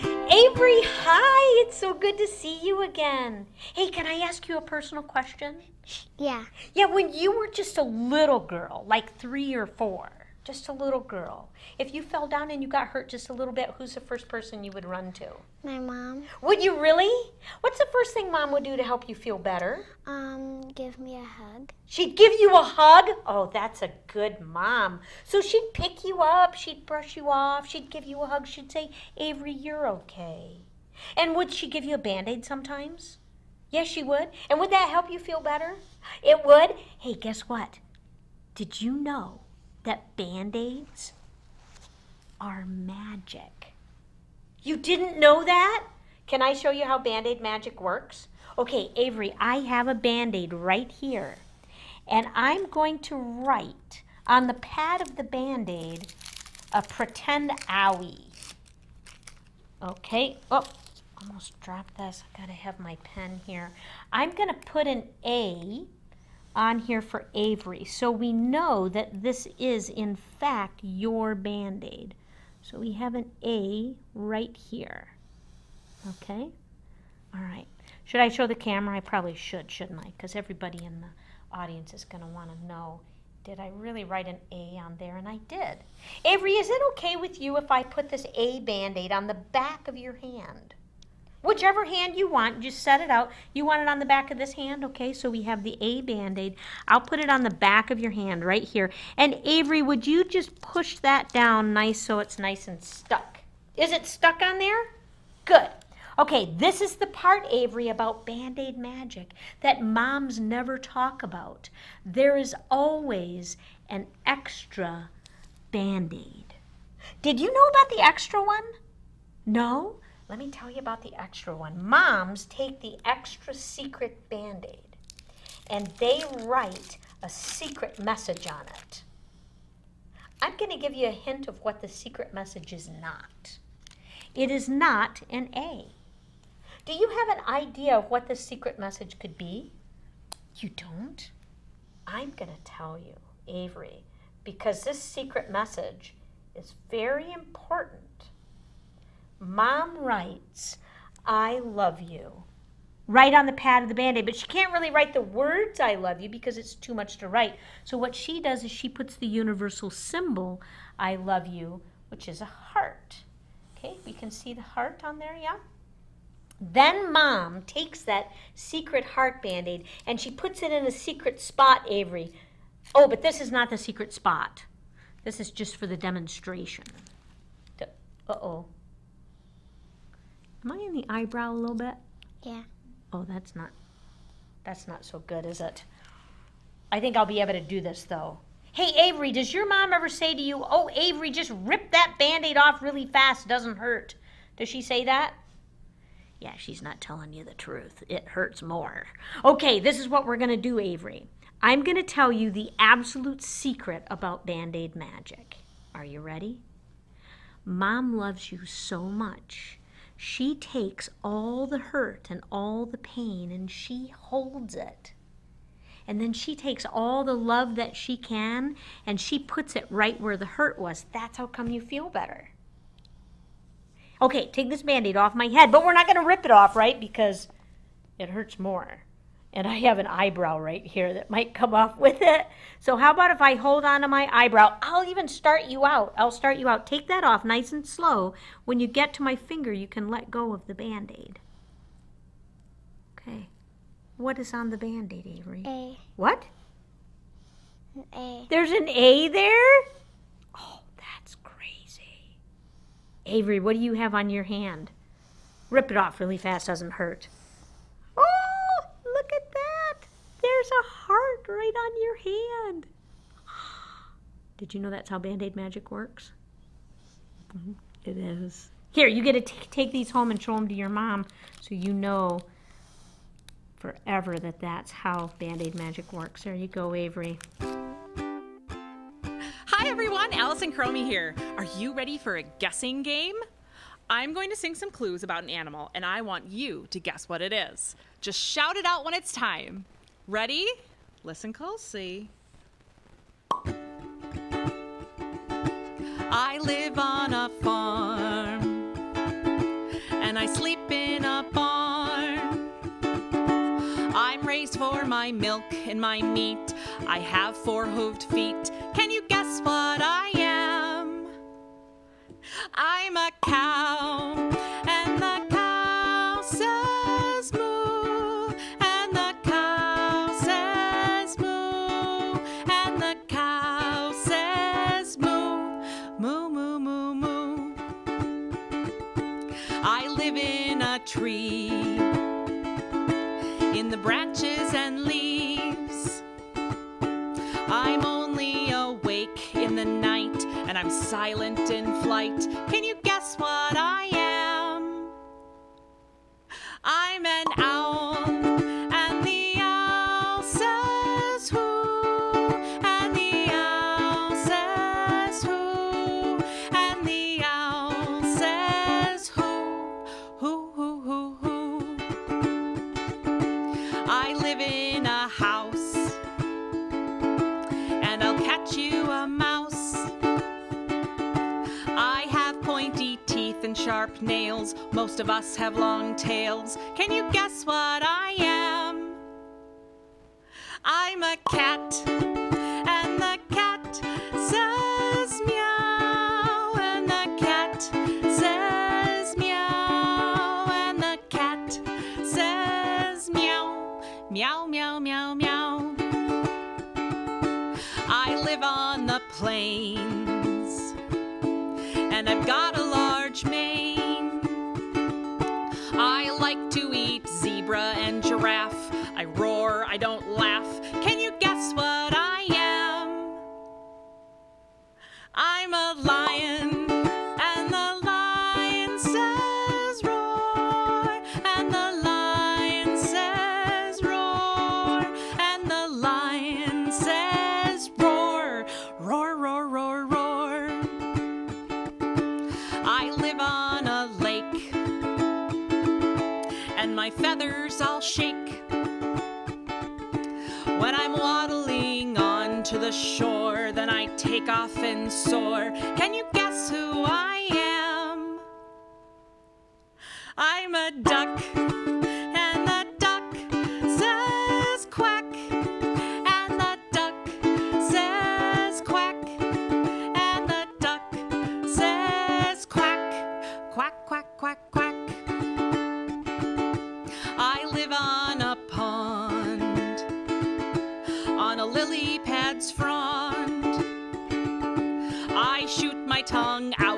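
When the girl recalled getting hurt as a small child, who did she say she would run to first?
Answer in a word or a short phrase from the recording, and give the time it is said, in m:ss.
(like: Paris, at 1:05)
My mom, at 0:15.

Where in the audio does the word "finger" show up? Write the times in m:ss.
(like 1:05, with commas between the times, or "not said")
3:59.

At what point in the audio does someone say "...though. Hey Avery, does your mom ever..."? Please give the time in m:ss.
3:08.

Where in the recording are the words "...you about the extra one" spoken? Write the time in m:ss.
2:00.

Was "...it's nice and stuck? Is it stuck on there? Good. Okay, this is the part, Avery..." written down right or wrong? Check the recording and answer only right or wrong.
right.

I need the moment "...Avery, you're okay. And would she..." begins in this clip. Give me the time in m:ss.
0:29.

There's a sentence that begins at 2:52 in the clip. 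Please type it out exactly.
Oh, but this is not the secret spot.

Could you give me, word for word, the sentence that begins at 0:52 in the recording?
And I'm going to write on the pad of the Band-Aid a pretend owie.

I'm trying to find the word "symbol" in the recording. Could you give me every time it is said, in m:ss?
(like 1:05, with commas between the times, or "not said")
2:39.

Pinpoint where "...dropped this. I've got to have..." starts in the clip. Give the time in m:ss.
1:01.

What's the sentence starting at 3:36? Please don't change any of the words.
And then she takes all the love that she can and she puts it right where the hurt was.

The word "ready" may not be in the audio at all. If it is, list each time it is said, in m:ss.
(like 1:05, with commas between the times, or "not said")
3:26, 4:41, 4:50.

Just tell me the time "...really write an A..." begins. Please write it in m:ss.
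1:23.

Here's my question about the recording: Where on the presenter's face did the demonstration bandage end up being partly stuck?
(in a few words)
The eyebrow.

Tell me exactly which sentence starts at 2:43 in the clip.
Okay, we can see the heart on there, yeah?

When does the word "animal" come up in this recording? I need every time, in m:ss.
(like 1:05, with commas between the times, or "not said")
4:45.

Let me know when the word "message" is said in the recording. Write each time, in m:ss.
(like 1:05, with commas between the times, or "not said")
2:08, 2:12, 2:18, 2:25.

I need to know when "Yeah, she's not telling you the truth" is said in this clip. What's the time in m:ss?
3:16.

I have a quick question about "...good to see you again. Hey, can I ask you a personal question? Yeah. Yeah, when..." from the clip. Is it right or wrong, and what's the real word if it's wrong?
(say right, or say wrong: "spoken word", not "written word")
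right.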